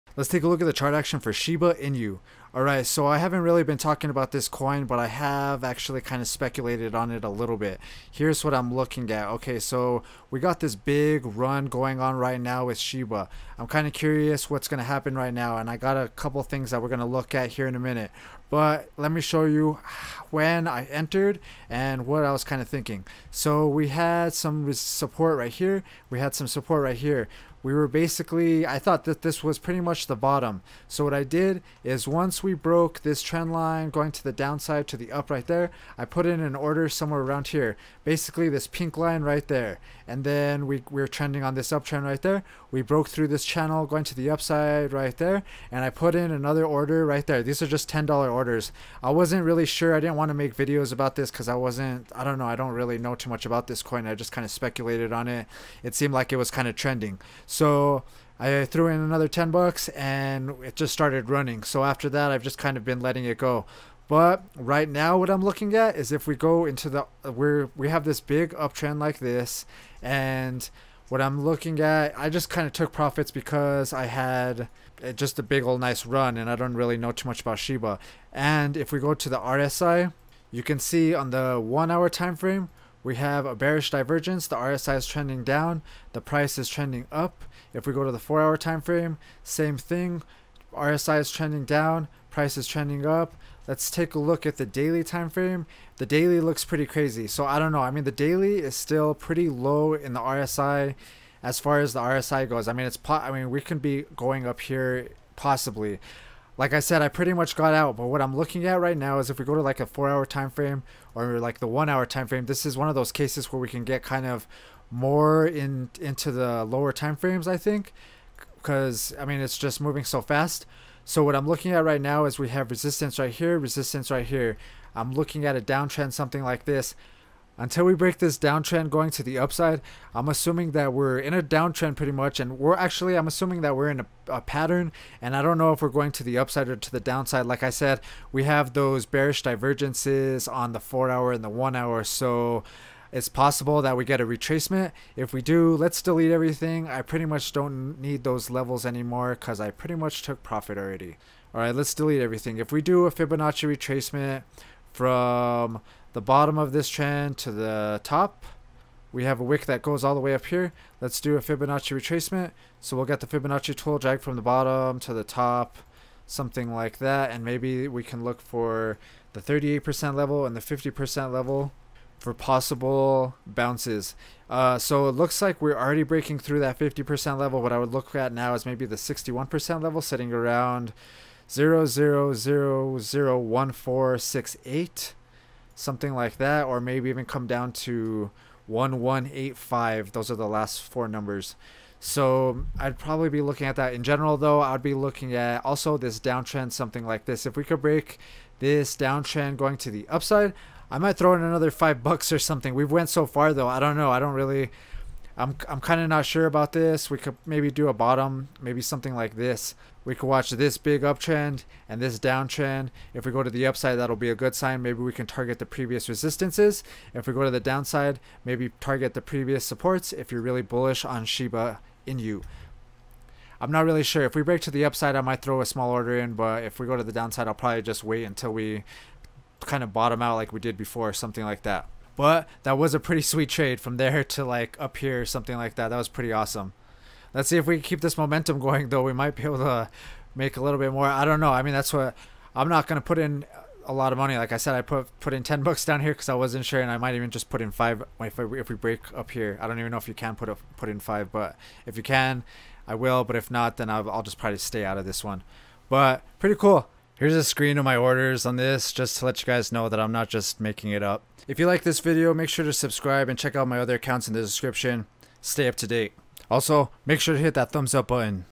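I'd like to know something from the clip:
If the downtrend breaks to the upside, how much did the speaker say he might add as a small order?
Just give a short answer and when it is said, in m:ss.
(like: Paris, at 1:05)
5 bucks, at 3:21.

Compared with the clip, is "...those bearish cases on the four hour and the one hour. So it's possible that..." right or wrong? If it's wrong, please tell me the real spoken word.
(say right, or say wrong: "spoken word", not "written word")
wrong: "divergences", not "cases".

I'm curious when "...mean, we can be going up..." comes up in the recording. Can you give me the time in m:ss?
1:43.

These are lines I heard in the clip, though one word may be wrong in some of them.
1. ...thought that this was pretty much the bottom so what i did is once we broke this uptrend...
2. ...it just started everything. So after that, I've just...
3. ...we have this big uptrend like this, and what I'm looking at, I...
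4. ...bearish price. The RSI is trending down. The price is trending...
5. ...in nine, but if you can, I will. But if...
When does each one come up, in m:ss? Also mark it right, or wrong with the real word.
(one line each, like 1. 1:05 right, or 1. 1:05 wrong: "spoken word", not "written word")
1. 0:28 wrong: "trend", not "uptrend"
2. 1:00 wrong: "running", not "everything"
3. 1:07 right
4. 1:23 wrong: "divergence", not "price"
5. 4:10 wrong: "five", not "nine".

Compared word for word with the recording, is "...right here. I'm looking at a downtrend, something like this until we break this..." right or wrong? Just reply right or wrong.
right.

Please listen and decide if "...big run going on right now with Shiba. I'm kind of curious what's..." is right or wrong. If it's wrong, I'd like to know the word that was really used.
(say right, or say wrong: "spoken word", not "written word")
right.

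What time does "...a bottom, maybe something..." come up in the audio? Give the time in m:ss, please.
3:27.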